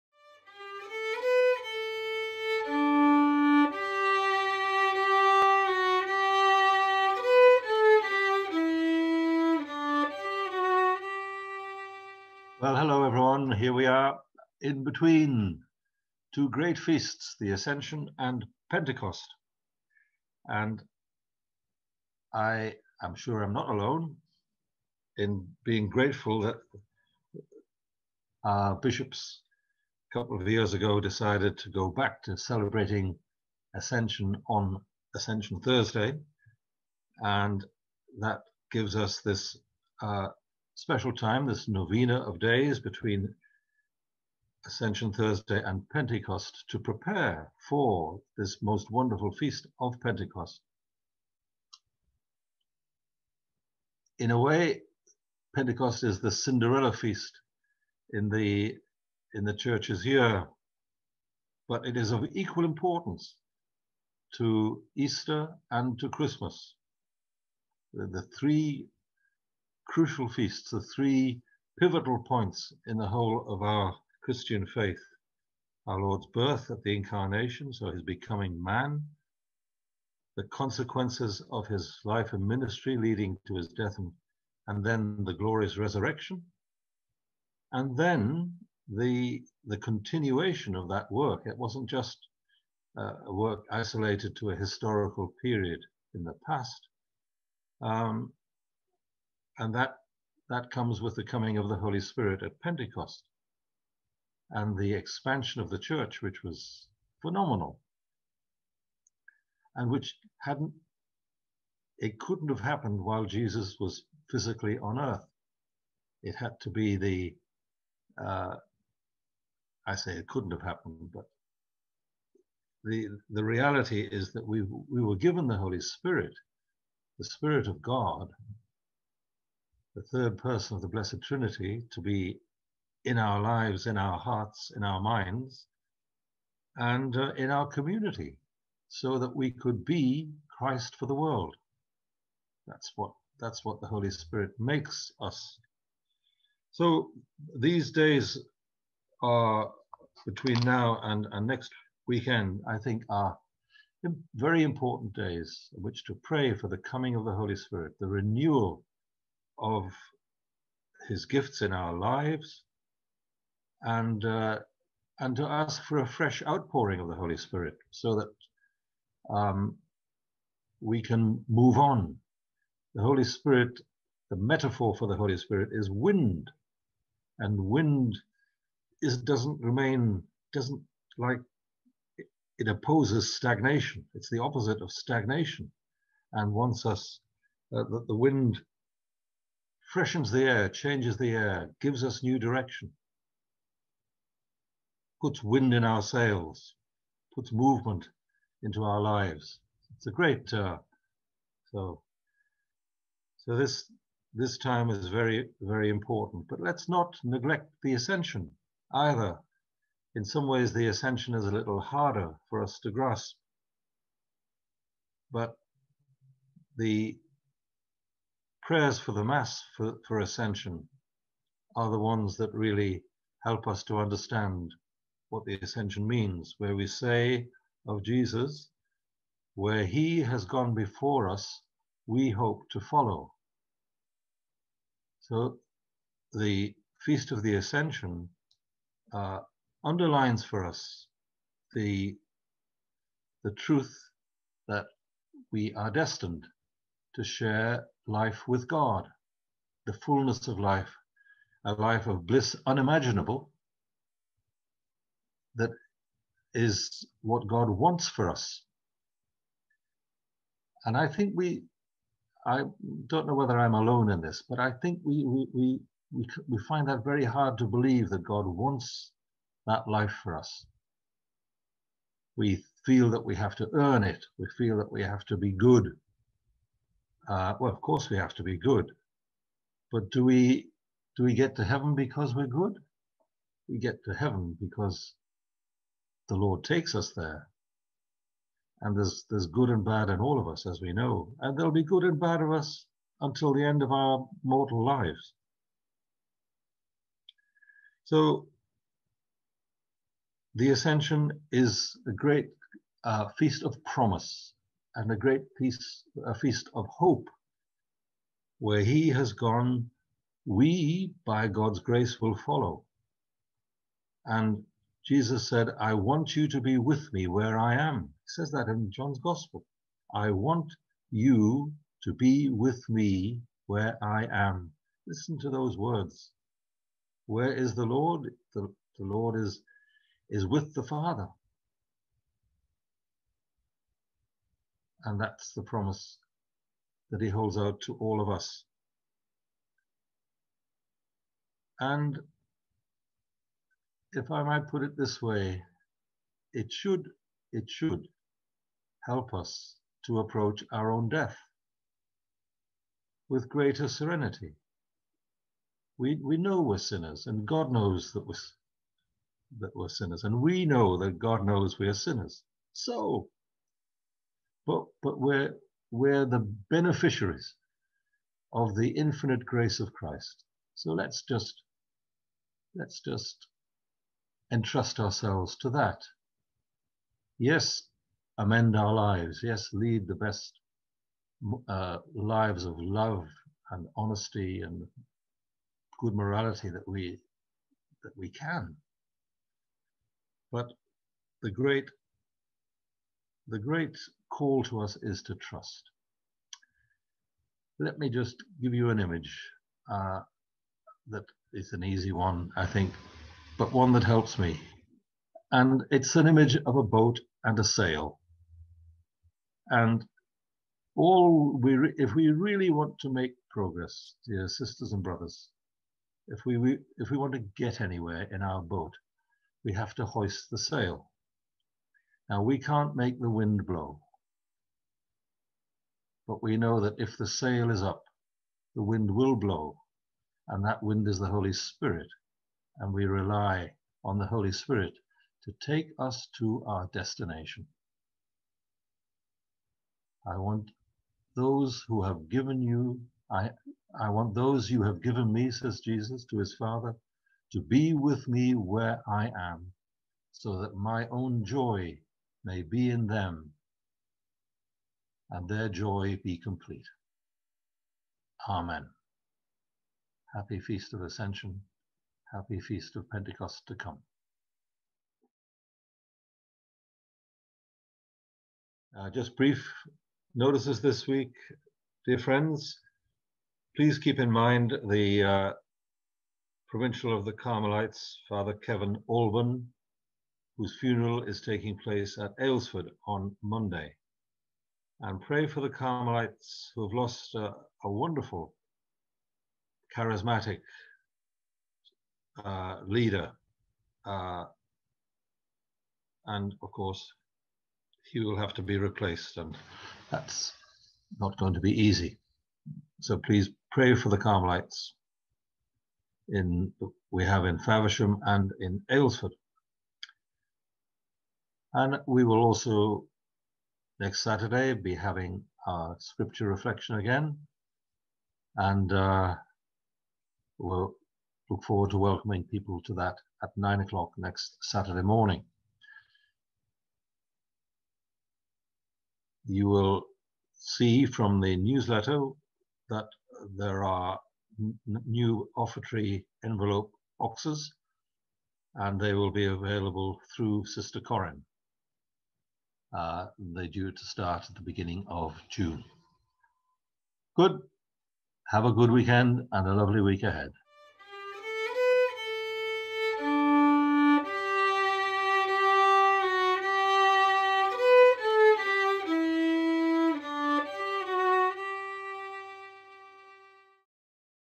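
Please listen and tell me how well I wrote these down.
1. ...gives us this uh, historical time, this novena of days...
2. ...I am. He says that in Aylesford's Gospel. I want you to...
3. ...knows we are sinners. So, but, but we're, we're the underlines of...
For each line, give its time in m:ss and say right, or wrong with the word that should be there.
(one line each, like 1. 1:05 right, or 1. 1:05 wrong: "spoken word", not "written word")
1. 0:38 wrong: "special", not "historical"
2. 5:17 wrong: "John", not "Aylesford"
3. 6:01 wrong: "beneficiaries", not "underlines".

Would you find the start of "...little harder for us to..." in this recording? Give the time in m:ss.
3:31.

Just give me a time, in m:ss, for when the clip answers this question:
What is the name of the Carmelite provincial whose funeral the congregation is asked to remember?
7:58.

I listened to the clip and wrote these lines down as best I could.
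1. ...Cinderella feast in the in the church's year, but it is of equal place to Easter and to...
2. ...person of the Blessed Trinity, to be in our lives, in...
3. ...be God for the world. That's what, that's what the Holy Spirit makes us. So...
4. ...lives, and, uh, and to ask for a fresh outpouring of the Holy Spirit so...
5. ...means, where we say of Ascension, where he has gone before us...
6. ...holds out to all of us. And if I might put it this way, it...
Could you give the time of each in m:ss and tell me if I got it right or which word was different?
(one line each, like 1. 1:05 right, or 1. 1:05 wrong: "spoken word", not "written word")
1. 0:56 wrong: "importance", not "place"
2. 2:10 right
3. 2:19 wrong: "Christ", not "God"
4. 2:41 right
5. 3:46 wrong: "Jesus", not "Ascension"
6. 5:37 right.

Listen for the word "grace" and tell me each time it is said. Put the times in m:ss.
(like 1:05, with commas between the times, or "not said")
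5:11, 6:09.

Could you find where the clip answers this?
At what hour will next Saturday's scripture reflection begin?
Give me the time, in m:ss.
8:43.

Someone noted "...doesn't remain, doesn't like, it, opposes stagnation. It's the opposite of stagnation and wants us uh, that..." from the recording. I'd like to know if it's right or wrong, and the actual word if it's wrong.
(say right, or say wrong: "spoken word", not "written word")
right.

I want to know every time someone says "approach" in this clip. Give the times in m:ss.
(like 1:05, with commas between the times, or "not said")
5:50.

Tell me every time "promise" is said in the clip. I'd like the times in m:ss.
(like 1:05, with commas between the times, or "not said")
5:03, 5:35.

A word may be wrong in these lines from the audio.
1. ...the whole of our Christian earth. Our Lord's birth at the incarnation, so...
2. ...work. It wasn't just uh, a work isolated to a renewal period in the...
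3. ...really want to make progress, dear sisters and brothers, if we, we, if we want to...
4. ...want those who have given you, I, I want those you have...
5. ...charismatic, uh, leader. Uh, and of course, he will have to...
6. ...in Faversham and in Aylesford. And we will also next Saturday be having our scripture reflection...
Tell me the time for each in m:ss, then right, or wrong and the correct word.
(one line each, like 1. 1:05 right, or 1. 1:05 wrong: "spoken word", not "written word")
1. 1:12 wrong: "faith", not "earth"
2. 1:31 wrong: "historical", not "renewal"
3. 6:52 right
4. 7:20 right
5. 8:09 right
6. 8:27 right.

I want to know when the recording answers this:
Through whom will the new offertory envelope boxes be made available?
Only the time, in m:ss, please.
9:00.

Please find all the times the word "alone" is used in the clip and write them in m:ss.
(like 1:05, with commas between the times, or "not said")
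0:23, 4:23.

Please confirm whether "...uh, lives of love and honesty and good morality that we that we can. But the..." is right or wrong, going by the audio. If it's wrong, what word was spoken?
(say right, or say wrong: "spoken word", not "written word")
right.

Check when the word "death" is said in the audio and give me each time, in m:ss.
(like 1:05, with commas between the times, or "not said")
1:23, 5:51.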